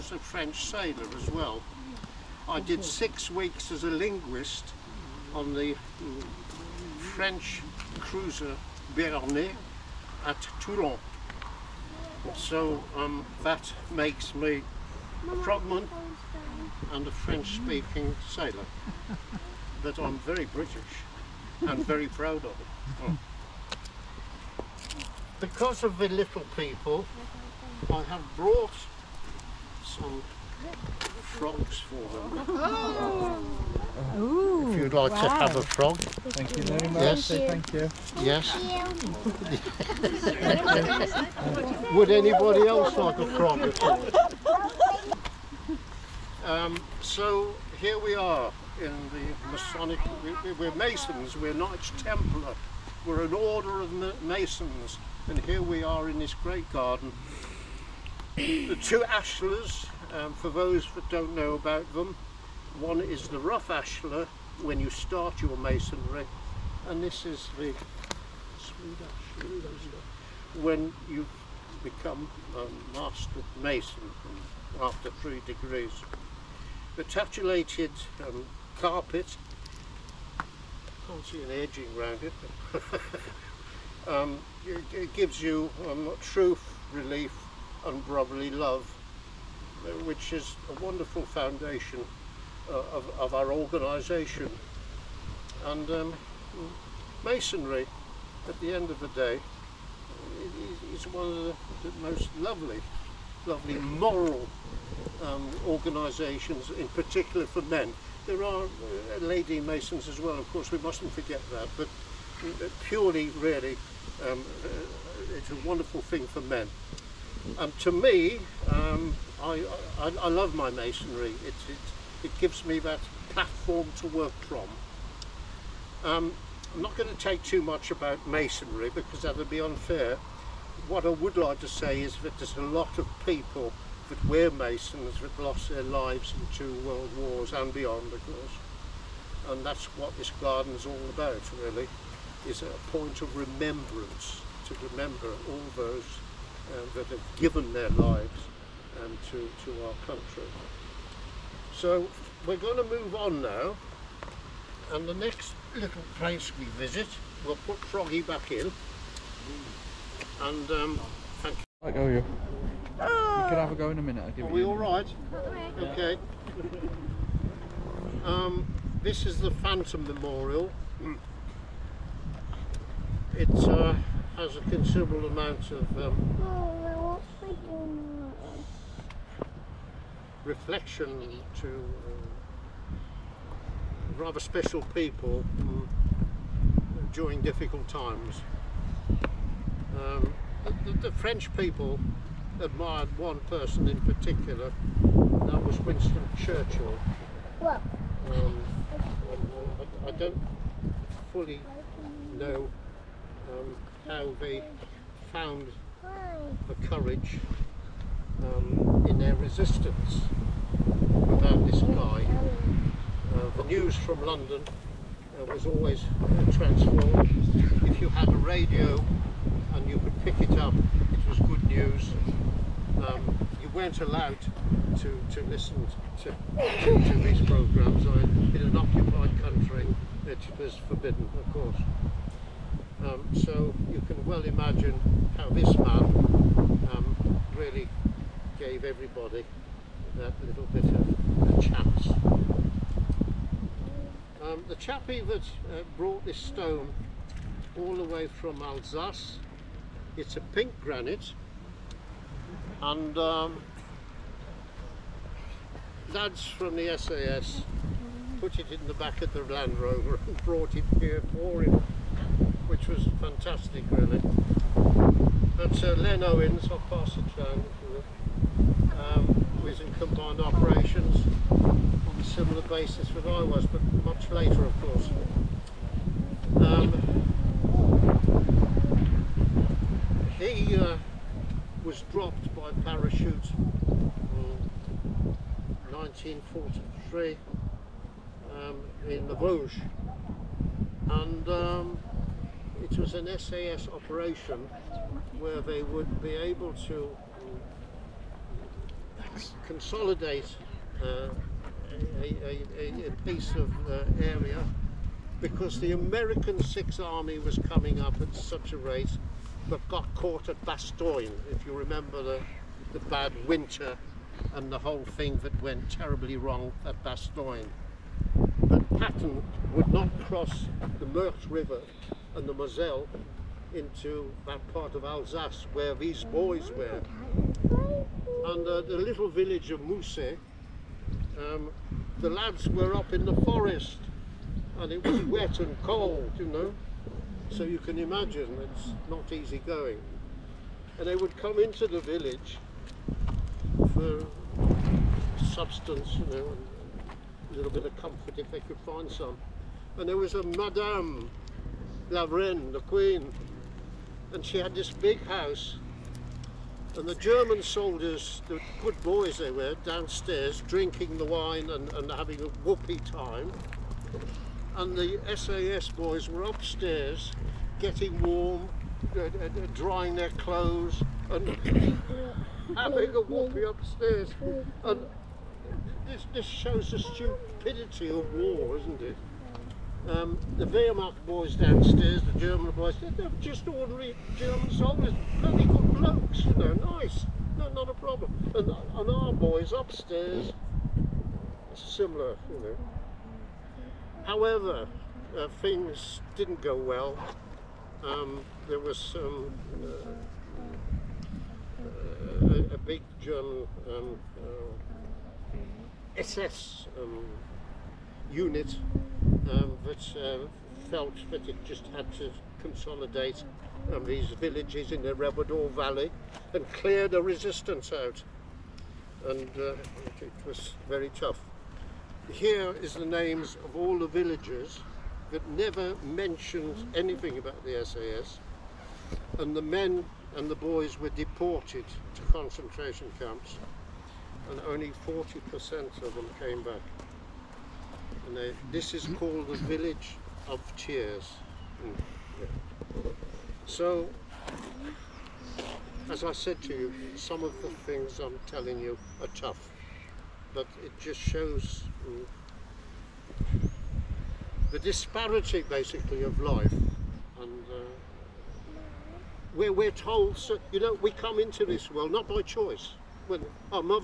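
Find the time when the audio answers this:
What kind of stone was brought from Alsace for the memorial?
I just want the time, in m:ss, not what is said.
4:10.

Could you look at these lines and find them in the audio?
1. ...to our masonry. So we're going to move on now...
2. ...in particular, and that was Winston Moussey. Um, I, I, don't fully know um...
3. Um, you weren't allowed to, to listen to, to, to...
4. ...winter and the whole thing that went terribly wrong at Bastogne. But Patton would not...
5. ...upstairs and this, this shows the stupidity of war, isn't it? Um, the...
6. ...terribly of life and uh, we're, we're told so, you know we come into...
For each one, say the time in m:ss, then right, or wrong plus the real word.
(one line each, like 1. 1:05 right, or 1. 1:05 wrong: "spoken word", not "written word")
1. 2:29 wrong: "country", not "masonry"
2. 3:13 wrong: "Churchill", not "Moussey"
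3. 3:43 right
4. 5:13 right
5. 6:13 right
6. 7:35 wrong: "basically", not "terribly".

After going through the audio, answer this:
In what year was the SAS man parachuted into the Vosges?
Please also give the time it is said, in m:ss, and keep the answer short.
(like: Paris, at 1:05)
1943, at 4:45.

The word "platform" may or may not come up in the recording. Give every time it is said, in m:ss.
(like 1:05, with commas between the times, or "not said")
2:03.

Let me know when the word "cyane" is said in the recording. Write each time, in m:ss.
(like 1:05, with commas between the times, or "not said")
not said.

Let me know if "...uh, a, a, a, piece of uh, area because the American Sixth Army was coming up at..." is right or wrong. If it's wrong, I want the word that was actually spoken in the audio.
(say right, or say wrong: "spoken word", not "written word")
right.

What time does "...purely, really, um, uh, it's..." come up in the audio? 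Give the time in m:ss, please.
1:52.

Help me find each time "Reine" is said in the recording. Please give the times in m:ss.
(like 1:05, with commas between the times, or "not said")
5:52.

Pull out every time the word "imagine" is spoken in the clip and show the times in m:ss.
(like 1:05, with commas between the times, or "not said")
3:54, 5:37.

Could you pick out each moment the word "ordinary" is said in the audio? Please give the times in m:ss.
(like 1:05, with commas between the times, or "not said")
6:23.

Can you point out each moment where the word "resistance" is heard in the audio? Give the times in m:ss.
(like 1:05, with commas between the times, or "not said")
3:29, 6:57.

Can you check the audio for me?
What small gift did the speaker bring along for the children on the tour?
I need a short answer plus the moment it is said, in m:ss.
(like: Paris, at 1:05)
frogs, at 0:31.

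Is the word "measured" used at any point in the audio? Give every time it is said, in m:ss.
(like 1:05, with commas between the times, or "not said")
not said.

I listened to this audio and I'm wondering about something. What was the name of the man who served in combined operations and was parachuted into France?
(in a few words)
Len Owens.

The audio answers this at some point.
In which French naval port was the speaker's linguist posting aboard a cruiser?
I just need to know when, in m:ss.
0:10.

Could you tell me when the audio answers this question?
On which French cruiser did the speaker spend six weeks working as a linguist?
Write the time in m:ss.
0:08.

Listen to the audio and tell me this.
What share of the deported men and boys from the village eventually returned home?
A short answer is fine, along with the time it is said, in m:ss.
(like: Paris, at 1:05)
40%, at 7:15.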